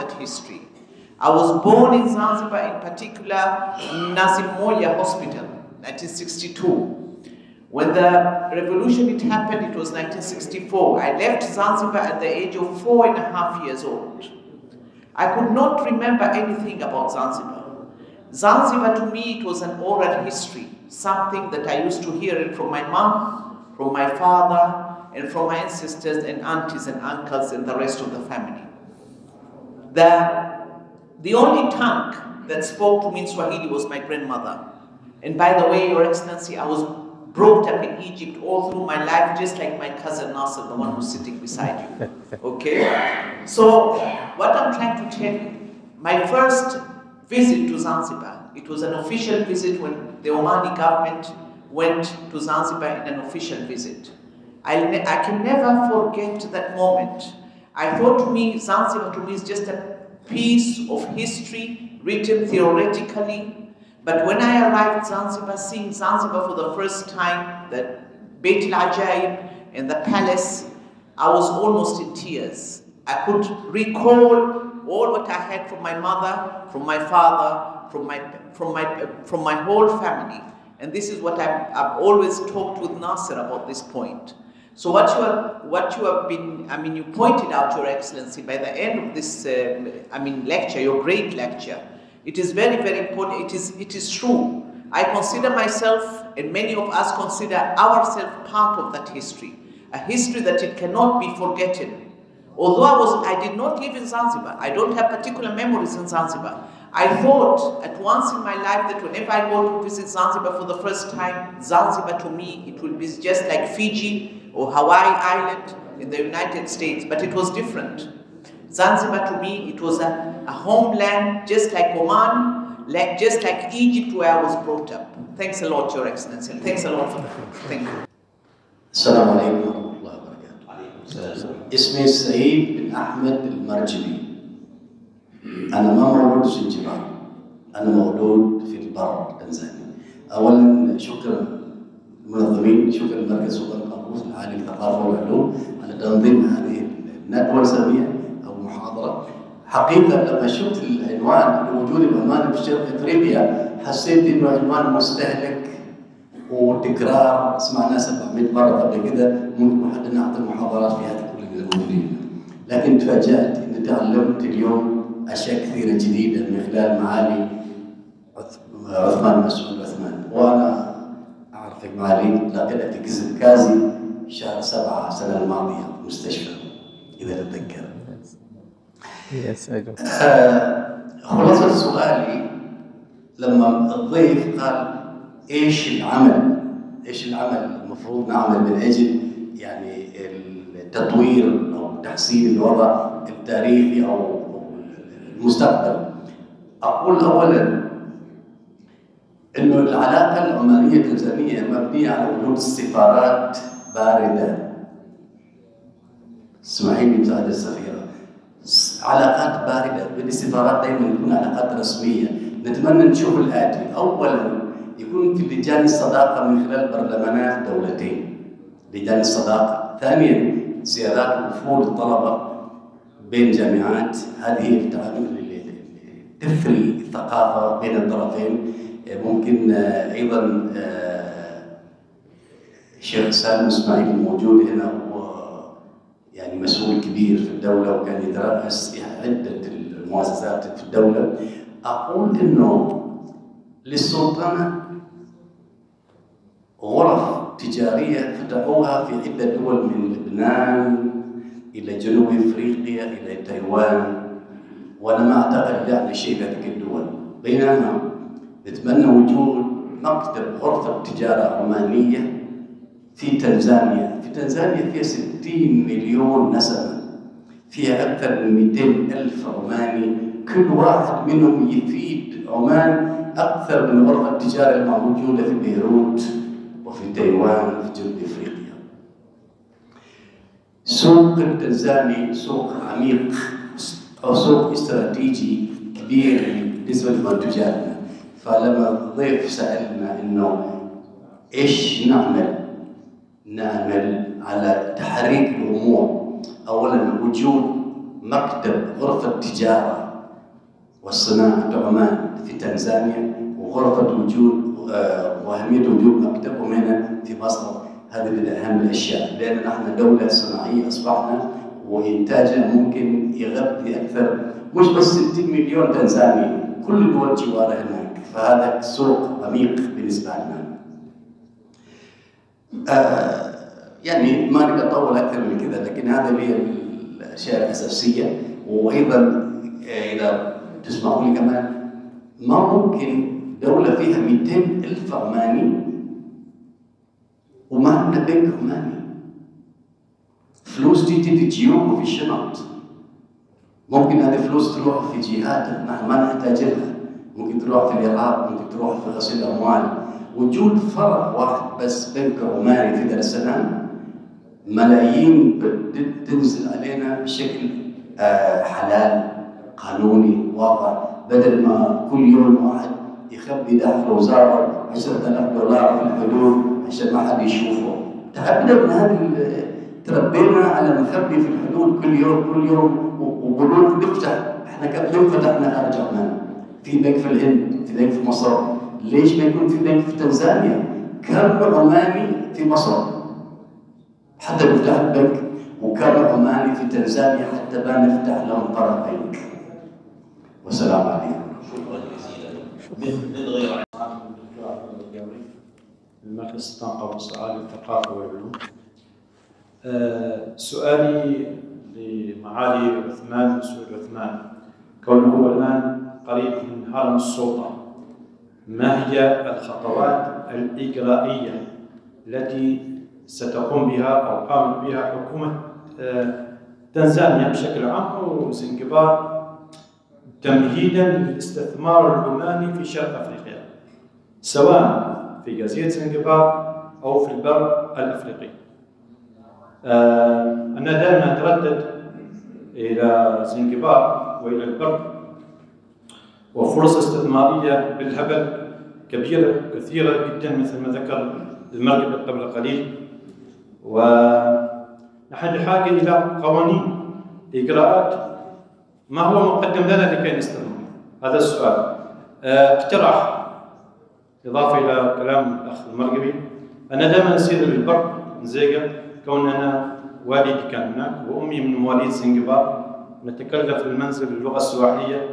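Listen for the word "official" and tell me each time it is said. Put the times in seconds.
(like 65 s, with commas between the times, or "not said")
49 s, 53 s.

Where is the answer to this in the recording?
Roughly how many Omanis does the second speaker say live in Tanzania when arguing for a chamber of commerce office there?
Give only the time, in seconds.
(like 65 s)
268 s.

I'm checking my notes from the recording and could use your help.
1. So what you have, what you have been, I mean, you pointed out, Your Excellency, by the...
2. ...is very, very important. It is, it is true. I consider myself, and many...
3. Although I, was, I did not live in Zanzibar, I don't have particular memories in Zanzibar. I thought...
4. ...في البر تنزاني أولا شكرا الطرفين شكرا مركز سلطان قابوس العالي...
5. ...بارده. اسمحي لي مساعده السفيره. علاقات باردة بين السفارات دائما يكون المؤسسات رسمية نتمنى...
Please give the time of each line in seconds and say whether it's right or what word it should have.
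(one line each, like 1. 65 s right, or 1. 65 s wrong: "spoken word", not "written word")
1. 84 s right
2. 92 s right
3. 102 s right
4. 138 s wrong: "المنظمين", not "الطرفين"
5. 203 s wrong: "علاقات", not "المؤسسات".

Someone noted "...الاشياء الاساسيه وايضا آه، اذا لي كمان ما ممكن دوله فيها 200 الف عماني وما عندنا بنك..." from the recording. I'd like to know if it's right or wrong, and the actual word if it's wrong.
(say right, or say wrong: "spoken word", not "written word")
right.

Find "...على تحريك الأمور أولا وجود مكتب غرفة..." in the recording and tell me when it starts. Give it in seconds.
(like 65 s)
294 s.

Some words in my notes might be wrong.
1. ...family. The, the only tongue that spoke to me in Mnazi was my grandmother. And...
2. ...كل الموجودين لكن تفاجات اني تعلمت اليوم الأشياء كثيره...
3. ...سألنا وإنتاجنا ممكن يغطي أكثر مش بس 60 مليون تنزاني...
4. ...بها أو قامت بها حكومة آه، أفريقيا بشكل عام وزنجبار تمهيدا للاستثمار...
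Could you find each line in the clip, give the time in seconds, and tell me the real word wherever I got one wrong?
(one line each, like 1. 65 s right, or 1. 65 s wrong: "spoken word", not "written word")
1. 28 s wrong: "Swahili", not "Mnazi"
2. 161 s wrong: "اشياء", not "الأشياء"
3. 310 s wrong: "أصبحنا", not "سألنا"
4. 413 s wrong: "تنزانيا", not "أفريقيا".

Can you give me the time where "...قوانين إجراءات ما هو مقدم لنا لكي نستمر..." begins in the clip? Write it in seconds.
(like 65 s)
446 s.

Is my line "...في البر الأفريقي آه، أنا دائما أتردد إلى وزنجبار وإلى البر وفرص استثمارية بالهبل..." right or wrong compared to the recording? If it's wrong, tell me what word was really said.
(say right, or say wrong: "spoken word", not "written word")
wrong: "زنجبار", not "وزنجبار".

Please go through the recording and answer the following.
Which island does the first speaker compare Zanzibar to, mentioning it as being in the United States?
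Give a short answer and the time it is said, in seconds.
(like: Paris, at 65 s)
Hawaii, at 114 s.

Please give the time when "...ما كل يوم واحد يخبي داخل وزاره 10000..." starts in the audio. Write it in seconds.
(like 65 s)
361 s.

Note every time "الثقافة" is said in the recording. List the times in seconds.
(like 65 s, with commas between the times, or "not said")
226 s, 397 s.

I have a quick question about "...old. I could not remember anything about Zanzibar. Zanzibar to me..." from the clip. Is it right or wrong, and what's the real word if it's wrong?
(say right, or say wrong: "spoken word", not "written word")
right.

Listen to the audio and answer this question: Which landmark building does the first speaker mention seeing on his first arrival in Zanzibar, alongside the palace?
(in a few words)
Beit Ajaib.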